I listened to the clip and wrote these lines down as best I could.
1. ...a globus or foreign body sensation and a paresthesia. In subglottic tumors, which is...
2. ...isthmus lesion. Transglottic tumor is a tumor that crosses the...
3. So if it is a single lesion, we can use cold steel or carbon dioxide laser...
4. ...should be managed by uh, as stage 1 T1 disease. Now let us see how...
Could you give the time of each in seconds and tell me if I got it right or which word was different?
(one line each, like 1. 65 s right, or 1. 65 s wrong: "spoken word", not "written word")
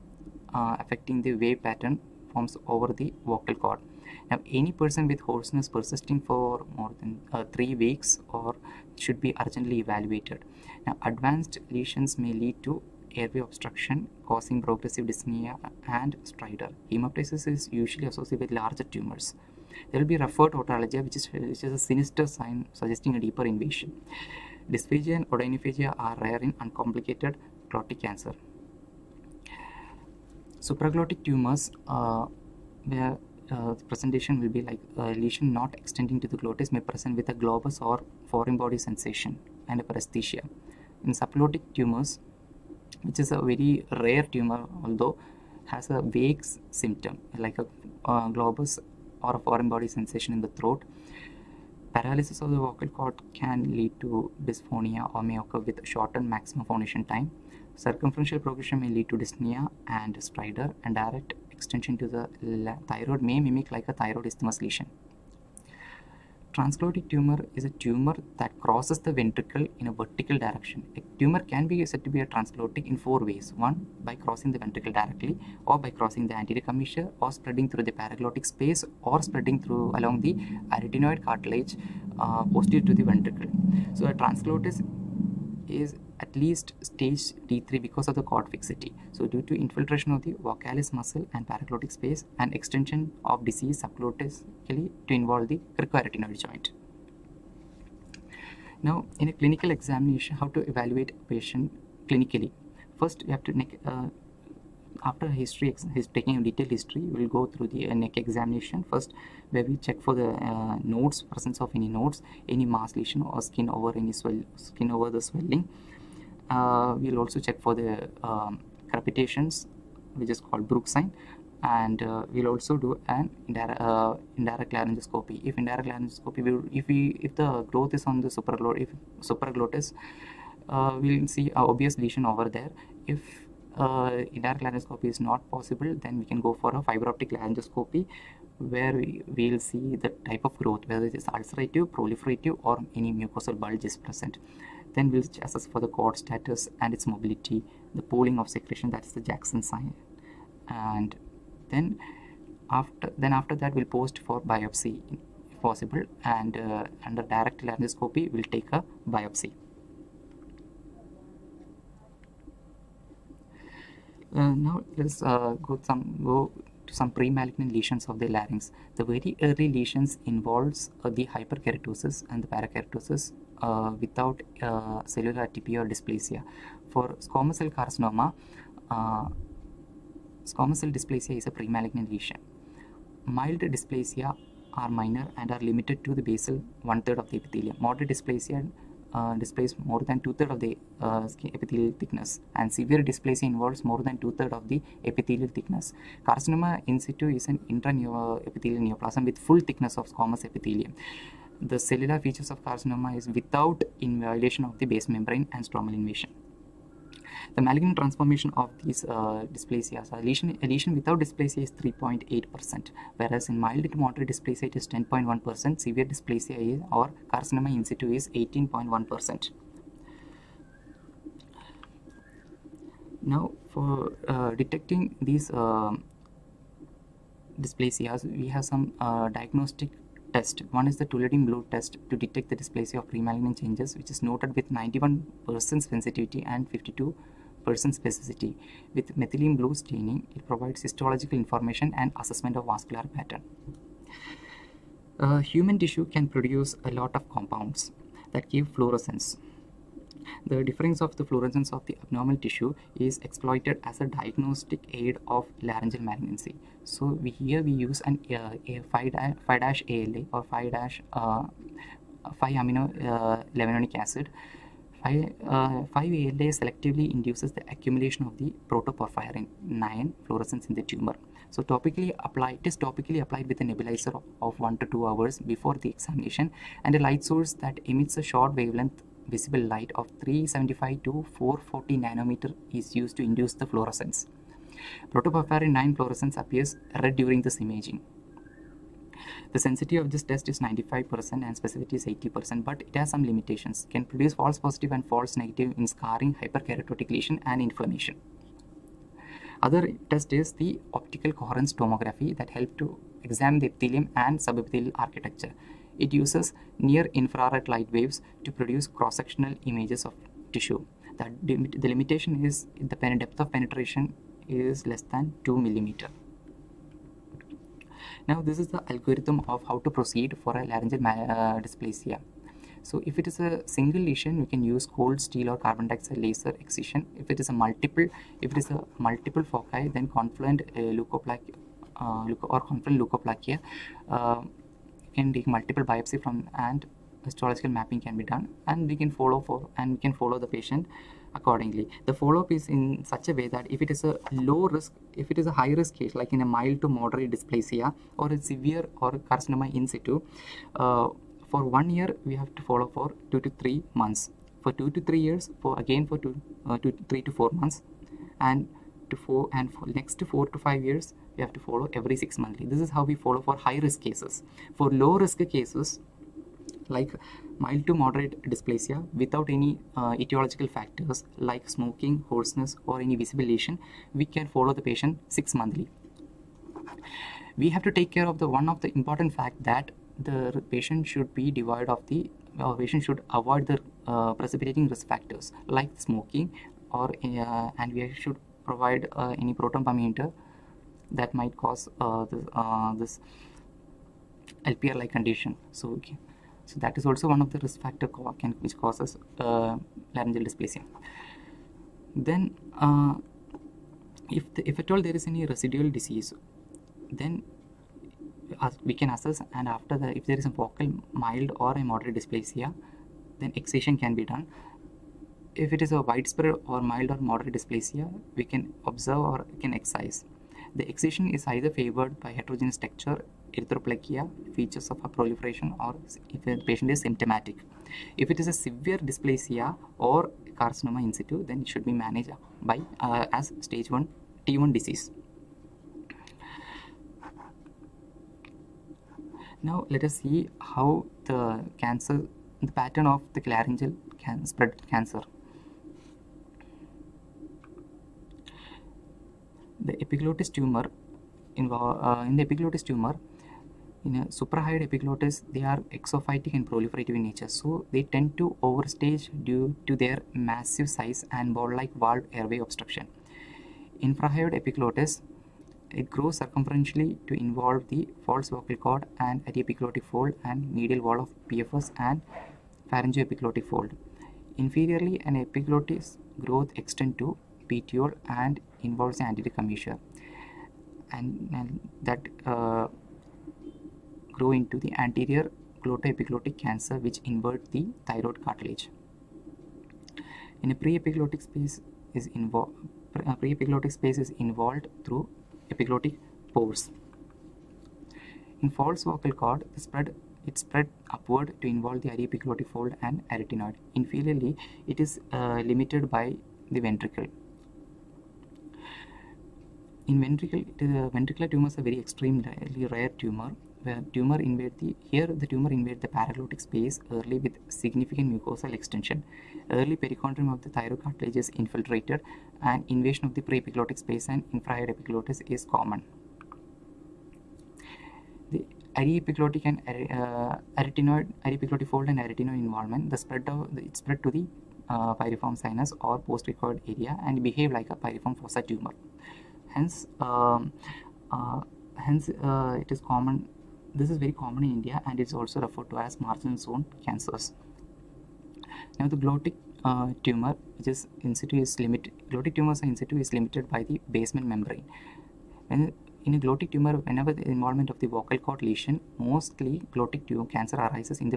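1. 37 s right
2. 64 s right
3. 322 s right
4. 431 s right.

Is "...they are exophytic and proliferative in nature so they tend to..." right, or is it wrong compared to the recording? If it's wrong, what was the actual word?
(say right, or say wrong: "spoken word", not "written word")
right.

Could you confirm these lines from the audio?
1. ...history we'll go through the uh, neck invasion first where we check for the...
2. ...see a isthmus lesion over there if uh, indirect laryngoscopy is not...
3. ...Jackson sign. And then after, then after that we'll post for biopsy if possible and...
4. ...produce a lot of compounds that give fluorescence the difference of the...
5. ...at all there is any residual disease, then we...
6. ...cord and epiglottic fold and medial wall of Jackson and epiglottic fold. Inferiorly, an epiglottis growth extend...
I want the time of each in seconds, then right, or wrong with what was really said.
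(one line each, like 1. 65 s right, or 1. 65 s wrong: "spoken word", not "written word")
1. 106 s wrong: "examination", not "invasion"
2. 131 s wrong: "obvious", not "isthmus"
3. 149 s right
4. 246 s right
5. 404 s right
6. 468 s wrong: "PFS", not "Jackson".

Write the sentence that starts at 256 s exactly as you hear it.
So we, here we use an uh, a 5-ALA or 5-5 uh, 5 amino uh, acid.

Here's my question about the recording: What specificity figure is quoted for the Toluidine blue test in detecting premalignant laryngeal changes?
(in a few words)
52%.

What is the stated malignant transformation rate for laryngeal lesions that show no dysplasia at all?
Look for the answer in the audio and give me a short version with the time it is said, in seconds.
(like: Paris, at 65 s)
3.8%, at 211 s.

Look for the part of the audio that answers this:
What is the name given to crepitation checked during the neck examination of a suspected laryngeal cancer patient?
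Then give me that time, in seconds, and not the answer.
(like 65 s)
120 s.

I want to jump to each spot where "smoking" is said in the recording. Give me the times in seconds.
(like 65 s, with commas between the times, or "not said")
371 s, 386 s.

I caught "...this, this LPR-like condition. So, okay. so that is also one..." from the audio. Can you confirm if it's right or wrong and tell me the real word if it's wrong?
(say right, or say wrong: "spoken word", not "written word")
right.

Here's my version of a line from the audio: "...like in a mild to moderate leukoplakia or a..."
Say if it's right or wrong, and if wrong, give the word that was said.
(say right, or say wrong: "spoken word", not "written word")
wrong: "dysplasia", not "leukoplakia".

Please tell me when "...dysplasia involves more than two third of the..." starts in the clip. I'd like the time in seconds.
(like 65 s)
193 s.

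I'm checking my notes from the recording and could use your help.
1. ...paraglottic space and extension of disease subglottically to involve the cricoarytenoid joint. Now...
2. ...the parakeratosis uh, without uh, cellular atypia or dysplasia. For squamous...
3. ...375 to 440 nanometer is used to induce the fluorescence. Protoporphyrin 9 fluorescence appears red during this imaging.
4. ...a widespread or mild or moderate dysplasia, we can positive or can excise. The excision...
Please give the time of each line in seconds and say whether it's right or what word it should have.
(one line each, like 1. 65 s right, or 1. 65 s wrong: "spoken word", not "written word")
1. 91 s right
2. 172 s right
3. 280 s right
4. 415 s wrong: "observe", not "positive".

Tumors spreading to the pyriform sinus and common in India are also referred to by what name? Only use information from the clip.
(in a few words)
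Marginal zone cancers.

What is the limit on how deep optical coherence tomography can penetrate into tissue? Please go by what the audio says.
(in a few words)
2 millimeters.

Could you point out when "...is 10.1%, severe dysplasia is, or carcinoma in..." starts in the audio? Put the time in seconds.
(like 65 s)
214 s.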